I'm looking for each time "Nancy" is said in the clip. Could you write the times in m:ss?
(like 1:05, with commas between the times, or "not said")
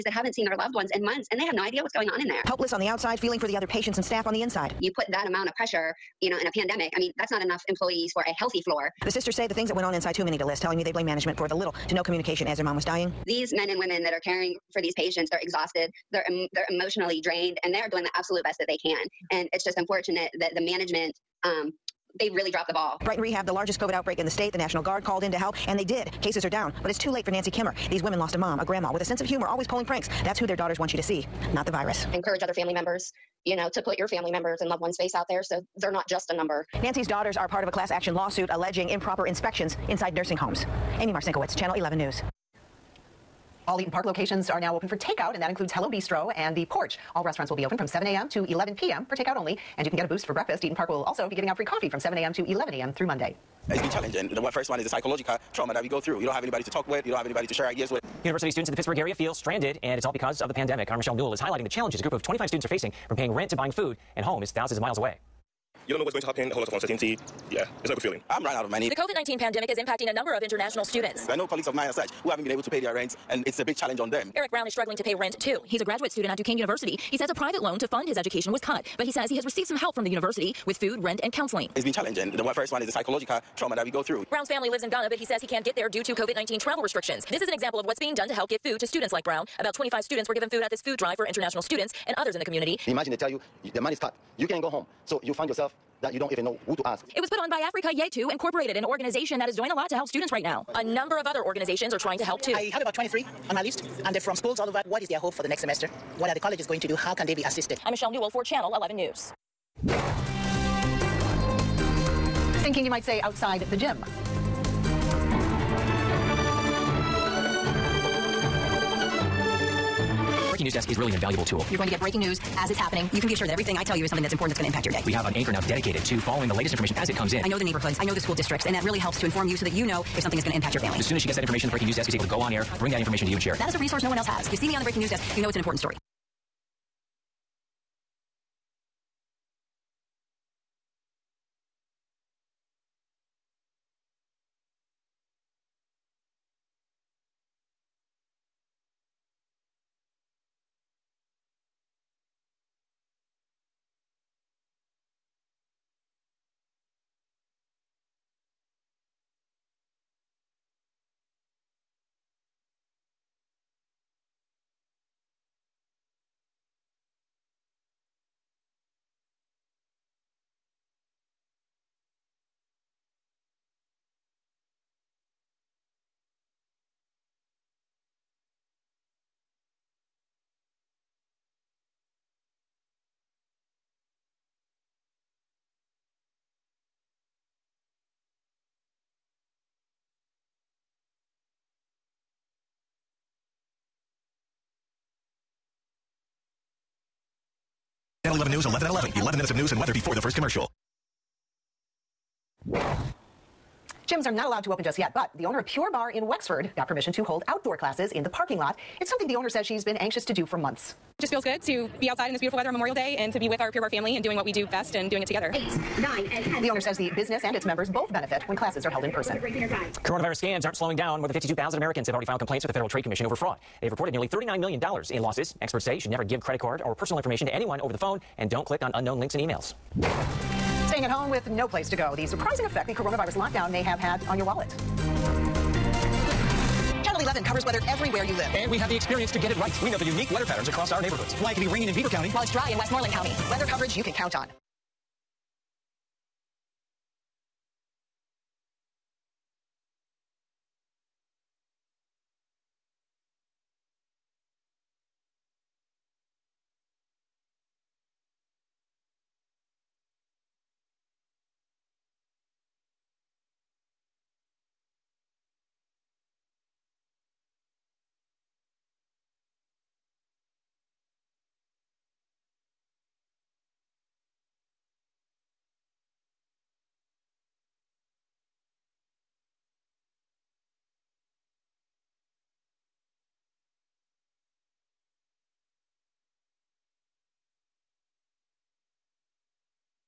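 0:27, 0:36.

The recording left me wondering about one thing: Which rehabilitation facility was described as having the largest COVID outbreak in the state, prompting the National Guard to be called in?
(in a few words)
Brighton Rehab.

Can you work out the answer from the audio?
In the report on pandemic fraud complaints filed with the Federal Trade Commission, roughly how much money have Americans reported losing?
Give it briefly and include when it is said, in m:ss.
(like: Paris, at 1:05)
$39 million, at 3:44.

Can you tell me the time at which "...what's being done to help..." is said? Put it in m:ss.
1:27.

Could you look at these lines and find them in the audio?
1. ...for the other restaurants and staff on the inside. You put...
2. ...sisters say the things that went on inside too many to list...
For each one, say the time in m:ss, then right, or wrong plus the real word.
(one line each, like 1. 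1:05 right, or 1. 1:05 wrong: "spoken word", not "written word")
1. 0:03 wrong: "patients", not "restaurants"
2. 0:09 right.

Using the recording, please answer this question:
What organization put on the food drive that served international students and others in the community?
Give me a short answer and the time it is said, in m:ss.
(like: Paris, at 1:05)
Africa Yetu Incorporated, at 1:37.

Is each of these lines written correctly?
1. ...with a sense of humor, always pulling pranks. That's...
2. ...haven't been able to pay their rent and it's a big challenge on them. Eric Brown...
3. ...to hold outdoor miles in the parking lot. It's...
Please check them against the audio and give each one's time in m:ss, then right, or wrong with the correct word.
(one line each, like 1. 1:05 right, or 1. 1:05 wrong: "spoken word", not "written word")
1. 0:28 right
2. 1:12 right
3. 3:27 wrong: "classes", not "miles".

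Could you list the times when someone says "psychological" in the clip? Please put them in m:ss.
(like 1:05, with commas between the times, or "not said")
0:54, 1:22.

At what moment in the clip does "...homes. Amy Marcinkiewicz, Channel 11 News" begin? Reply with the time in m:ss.
0:40.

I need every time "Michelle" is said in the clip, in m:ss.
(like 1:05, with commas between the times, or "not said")
1:00, 1:47.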